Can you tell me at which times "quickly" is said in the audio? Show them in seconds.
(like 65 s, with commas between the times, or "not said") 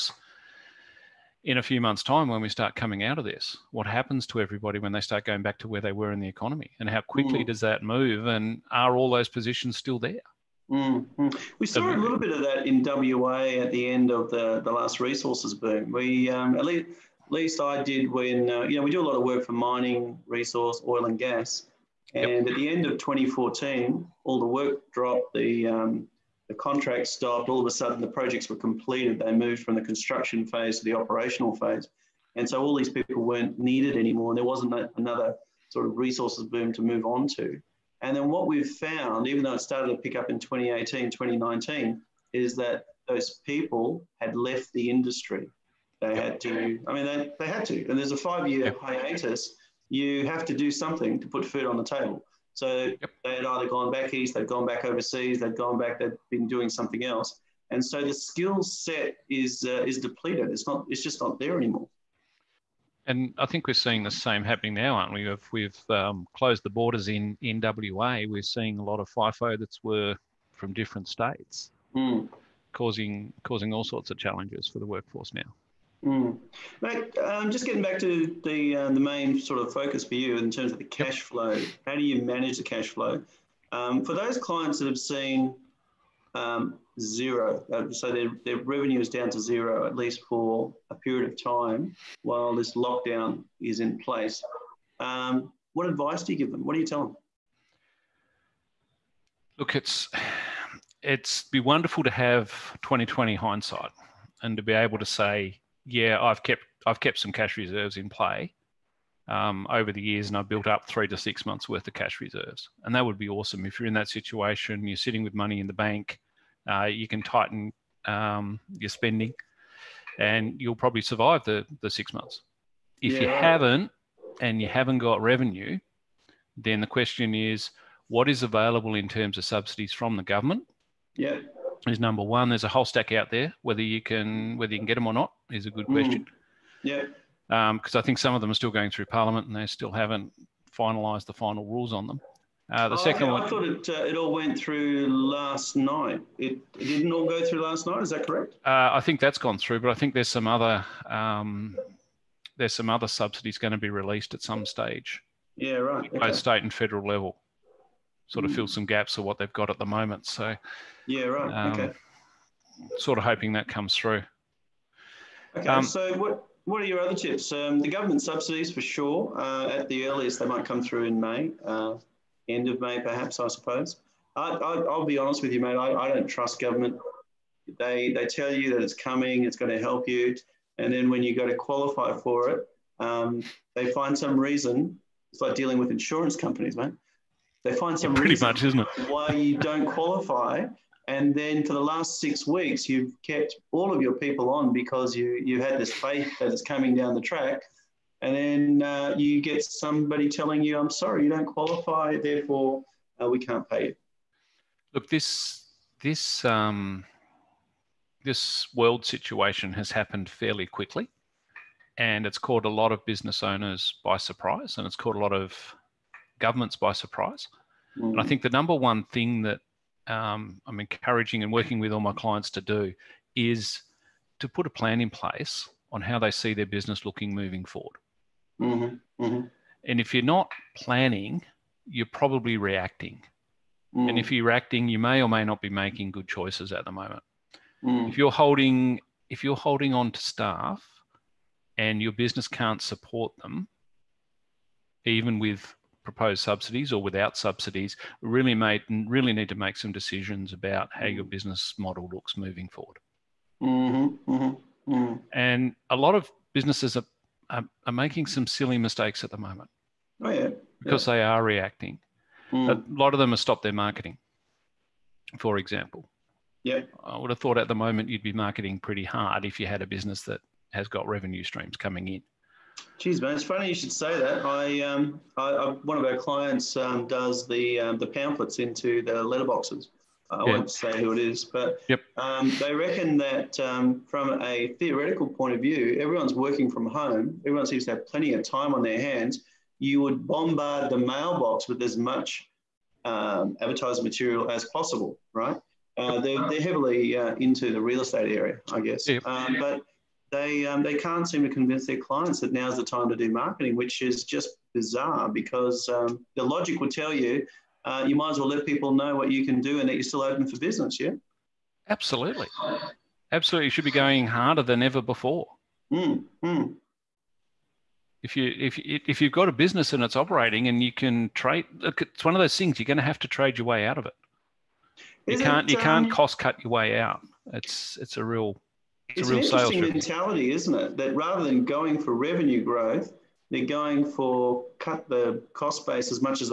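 7 s, 210 s.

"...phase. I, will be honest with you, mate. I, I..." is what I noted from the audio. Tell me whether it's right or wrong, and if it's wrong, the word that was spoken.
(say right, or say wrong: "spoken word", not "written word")
wrong: "suppose", not "phase".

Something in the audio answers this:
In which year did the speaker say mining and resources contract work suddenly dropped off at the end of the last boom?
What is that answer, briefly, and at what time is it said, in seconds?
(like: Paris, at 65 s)
2014, at 22 s.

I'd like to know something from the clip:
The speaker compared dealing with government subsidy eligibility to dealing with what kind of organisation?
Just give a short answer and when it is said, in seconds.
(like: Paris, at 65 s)
insurance companies, at 185 s.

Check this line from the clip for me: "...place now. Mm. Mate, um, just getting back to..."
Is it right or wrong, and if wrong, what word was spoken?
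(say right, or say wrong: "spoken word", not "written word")
wrong: "workforce", not "place".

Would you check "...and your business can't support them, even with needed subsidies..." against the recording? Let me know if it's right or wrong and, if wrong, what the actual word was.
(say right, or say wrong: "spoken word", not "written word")
wrong: "proposed", not "needed".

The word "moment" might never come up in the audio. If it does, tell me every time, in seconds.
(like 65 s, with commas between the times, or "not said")
159 s, 236 s, 259 s, 267 s.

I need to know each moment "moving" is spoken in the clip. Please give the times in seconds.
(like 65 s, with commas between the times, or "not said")
227 s, 252 s.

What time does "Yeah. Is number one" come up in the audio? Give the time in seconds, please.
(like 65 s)
131 s.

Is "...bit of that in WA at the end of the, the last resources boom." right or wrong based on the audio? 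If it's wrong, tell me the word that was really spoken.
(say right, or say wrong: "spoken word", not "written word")
right.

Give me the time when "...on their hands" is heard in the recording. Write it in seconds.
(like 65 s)
288 s.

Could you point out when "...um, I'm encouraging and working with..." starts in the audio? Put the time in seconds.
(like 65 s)
220 s.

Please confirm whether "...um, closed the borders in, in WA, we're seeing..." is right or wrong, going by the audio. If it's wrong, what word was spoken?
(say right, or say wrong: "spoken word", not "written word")
right.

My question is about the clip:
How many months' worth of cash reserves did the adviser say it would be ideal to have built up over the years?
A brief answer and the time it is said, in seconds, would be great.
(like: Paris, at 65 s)
3 to 6 months, at 110 s.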